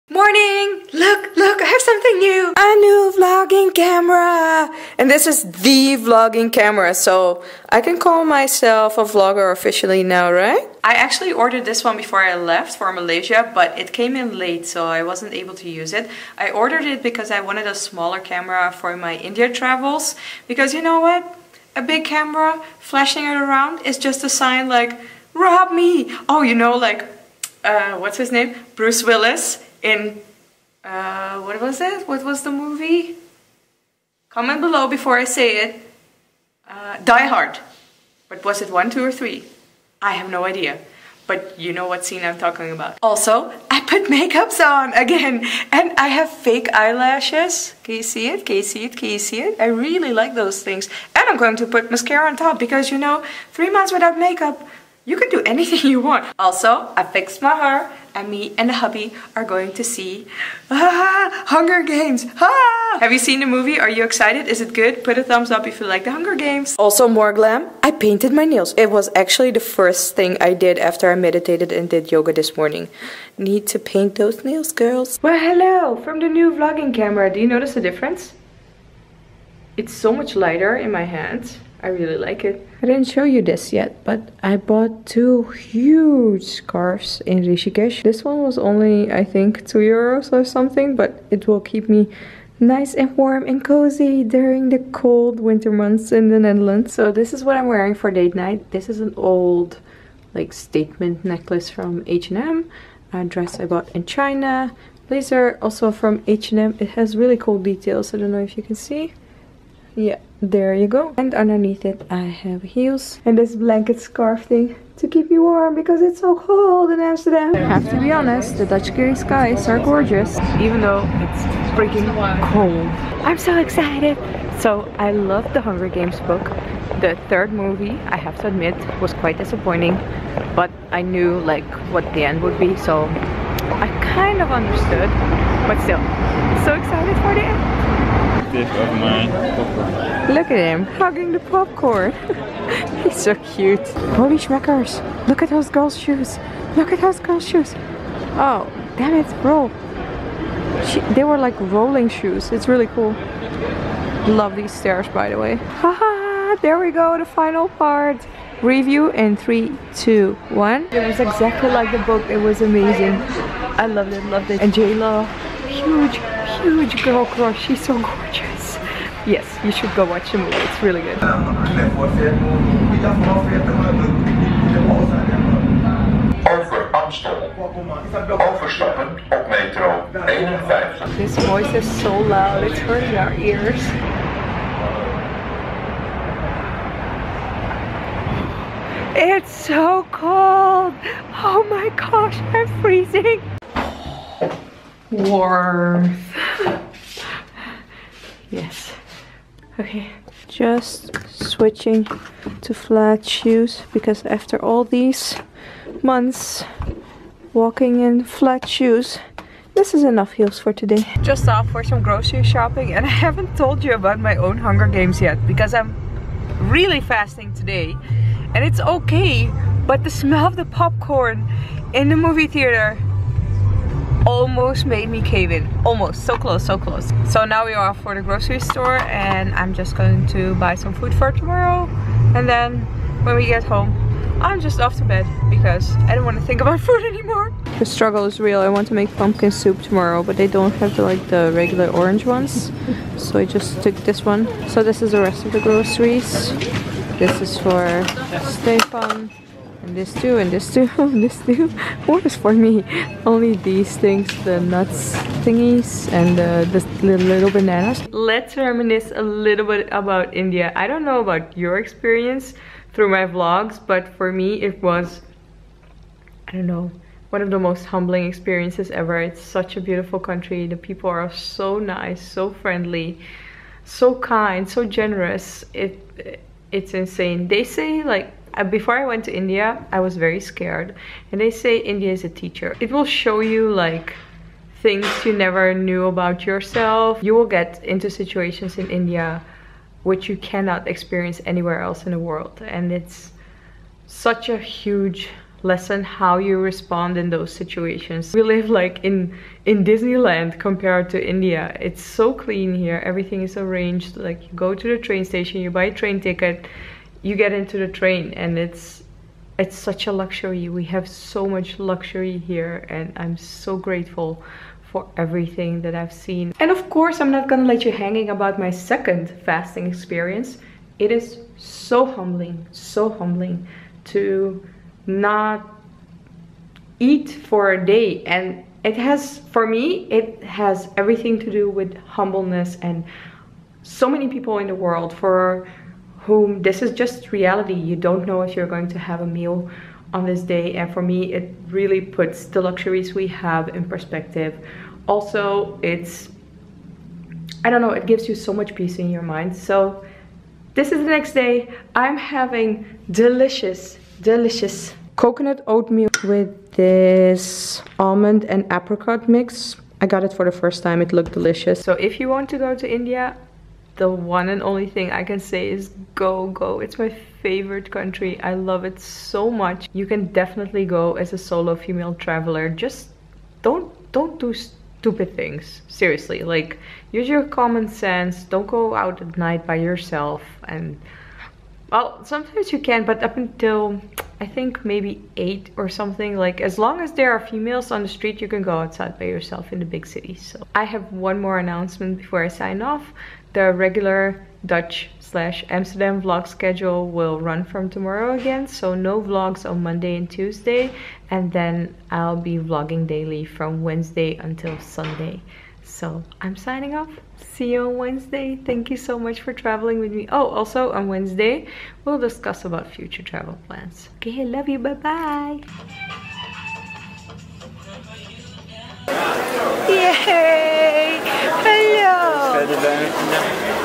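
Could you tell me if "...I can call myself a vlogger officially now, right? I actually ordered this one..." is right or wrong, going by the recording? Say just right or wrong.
right.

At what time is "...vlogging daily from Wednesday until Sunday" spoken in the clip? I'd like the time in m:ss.
6:42.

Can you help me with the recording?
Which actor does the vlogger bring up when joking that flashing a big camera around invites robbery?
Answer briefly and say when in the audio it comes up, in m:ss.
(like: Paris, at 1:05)
Bruce Willis, at 0:28.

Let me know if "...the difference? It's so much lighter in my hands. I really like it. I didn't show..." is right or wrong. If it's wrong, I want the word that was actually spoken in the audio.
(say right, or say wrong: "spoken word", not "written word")
right.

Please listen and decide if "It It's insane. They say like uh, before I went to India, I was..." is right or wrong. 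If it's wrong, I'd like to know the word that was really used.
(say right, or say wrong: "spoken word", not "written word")
right.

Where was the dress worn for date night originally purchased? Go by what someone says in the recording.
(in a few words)
China.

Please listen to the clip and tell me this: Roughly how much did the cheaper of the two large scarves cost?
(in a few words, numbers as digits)
2 euros.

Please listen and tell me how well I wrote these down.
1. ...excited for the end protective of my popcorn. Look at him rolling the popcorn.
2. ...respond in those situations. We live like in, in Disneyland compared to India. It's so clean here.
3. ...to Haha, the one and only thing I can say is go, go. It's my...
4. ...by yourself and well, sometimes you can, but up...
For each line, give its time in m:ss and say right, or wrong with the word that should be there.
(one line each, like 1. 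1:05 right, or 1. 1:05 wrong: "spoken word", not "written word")
1. 2:16 wrong: "hugging", not "rolling"
2. 4:56 right
3. 6:02 wrong: "India", not "Haha"
4. 6:19 right.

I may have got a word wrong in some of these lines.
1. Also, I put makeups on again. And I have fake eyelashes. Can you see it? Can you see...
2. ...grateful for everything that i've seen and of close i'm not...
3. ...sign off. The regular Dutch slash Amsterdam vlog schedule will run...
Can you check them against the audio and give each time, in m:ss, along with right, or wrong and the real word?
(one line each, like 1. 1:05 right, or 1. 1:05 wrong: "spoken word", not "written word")
1. 0:43 right
2. 5:13 wrong: "course", not "close"
3. 6:32 right.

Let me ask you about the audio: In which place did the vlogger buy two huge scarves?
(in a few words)
Rishikesh.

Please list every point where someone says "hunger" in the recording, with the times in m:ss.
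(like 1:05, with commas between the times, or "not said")
1:01, 1:06, 2:05, 3:34.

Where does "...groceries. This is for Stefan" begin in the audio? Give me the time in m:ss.
4:05.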